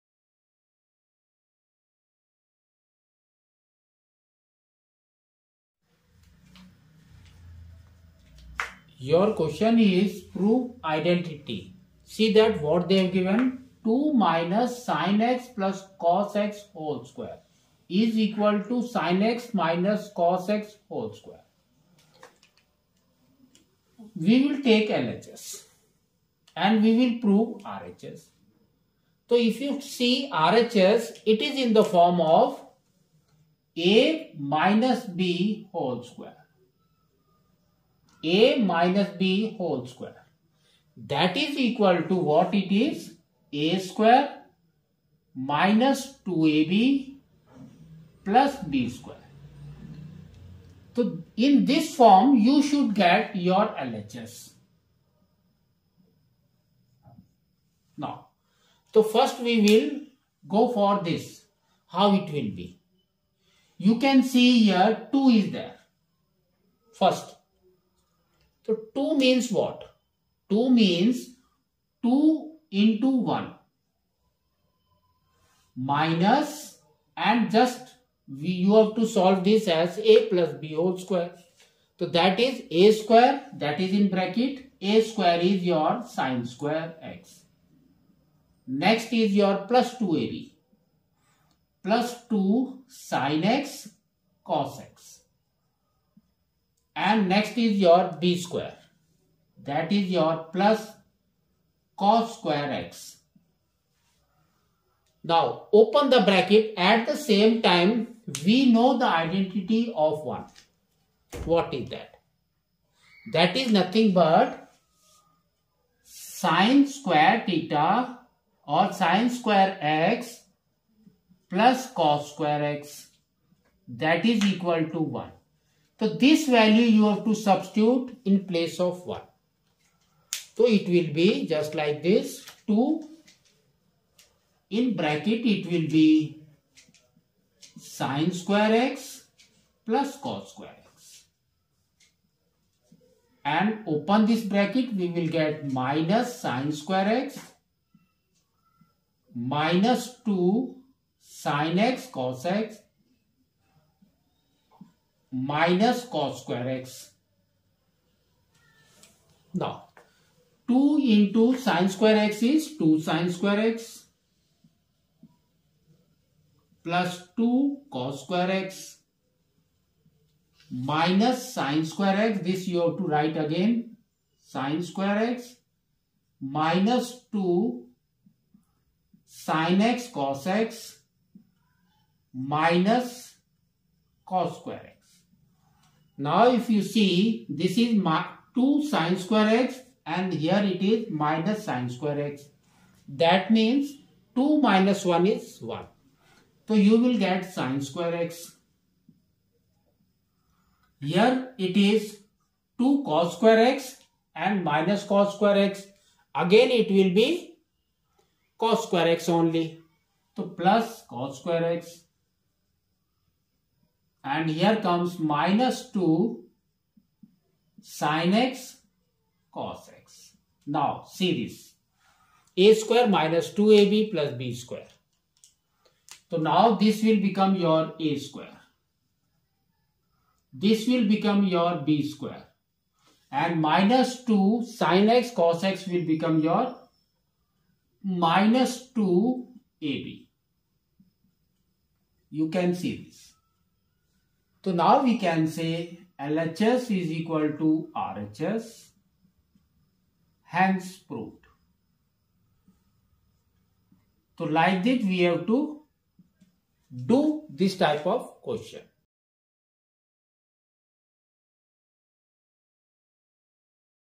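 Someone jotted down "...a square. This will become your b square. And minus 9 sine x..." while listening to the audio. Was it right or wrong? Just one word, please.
wrong.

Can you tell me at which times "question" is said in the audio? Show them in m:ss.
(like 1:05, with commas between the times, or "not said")
0:09, 4:18.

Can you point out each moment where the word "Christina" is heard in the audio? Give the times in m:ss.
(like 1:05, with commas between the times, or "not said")
not said.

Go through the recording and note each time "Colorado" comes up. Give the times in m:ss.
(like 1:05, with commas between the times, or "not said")
not said.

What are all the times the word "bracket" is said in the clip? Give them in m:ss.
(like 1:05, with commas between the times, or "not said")
1:24, 1:46, 2:14, 2:24.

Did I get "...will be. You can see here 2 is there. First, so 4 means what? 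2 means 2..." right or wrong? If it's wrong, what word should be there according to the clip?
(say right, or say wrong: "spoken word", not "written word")
wrong: "2", not "4".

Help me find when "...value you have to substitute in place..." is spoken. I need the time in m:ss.
2:06.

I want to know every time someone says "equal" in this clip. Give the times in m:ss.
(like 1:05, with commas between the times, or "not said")
0:18, 0:41, 2:04, 4:07.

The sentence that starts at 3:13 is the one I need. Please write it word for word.
That means 2 minus 1 is 1.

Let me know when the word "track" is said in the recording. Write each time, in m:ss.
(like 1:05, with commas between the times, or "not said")
not said.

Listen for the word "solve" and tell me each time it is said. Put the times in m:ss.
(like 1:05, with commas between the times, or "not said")
1:19.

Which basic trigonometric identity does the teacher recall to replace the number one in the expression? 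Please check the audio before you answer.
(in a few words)
sin²x + cos²x = 1.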